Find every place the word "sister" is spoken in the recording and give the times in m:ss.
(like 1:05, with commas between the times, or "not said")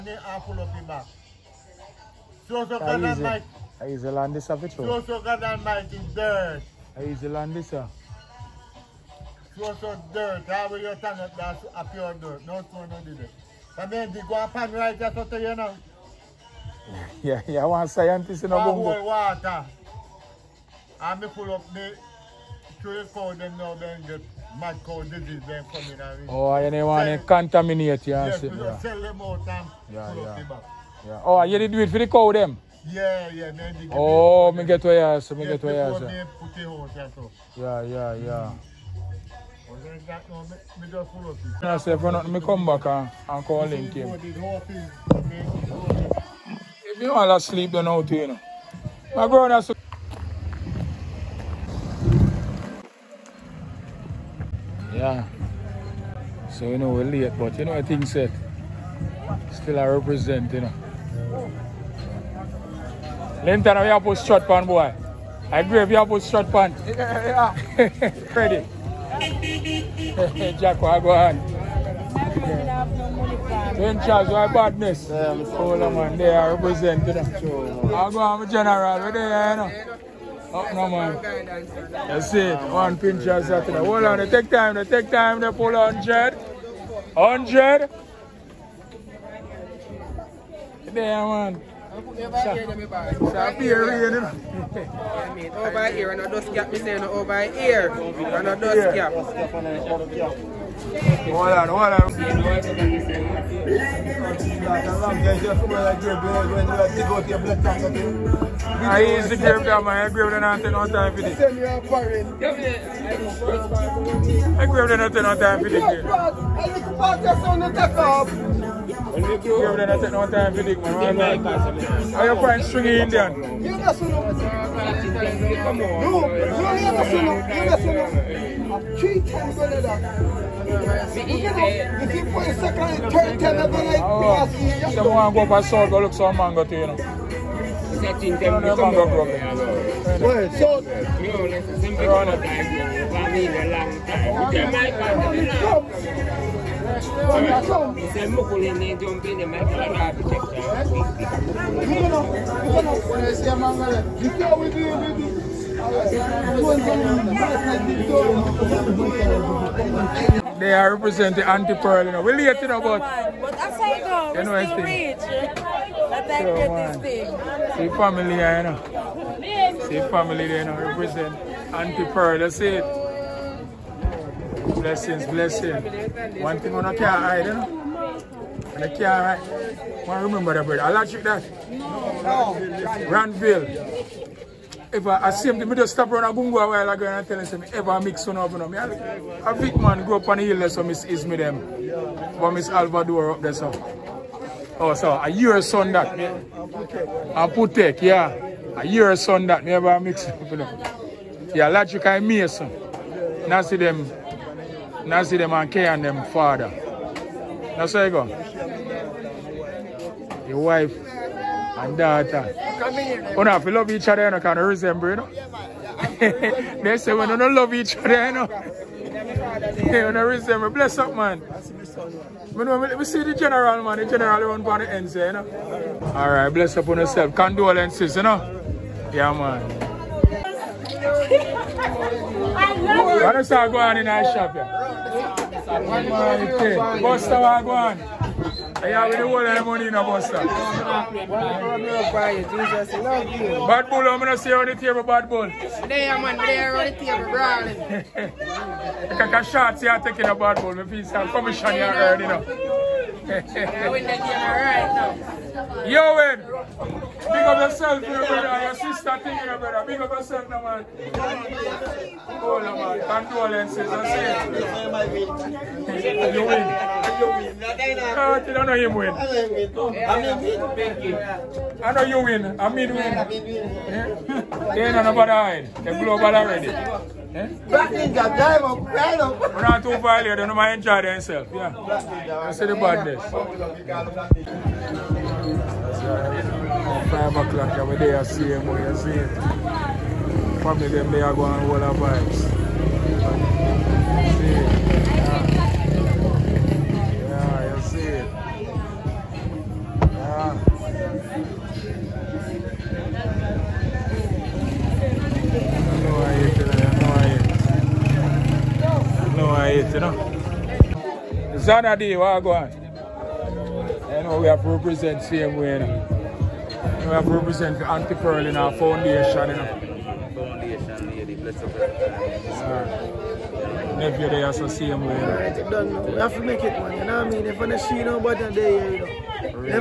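4:18.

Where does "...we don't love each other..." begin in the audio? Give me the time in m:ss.
3:37.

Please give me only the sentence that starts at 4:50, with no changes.
Family, them, they are going all the vibes.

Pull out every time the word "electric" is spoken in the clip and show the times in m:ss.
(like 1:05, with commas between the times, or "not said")
3:00, 3:21.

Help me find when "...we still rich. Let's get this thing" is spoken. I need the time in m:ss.
2:44.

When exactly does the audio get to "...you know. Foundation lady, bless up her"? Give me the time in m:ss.
5:19.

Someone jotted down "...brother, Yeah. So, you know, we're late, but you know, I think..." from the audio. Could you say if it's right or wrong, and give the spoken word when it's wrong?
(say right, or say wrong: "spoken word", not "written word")
right.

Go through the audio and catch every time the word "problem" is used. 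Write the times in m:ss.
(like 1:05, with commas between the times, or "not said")
2:19.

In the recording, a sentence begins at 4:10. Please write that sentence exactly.
If feel some commission here already now.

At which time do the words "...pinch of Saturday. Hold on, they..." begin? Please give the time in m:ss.
1:22.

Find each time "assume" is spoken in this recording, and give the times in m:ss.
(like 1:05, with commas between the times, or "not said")
3:05.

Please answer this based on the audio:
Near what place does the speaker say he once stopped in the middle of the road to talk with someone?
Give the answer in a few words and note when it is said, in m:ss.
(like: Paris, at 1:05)
Gungo, at 3:06.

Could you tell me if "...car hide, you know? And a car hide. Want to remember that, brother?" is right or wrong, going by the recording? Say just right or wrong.
right.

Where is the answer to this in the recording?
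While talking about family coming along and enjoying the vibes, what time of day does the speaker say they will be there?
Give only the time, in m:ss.
4:47.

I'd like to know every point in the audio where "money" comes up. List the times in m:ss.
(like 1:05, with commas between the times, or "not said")
3:59.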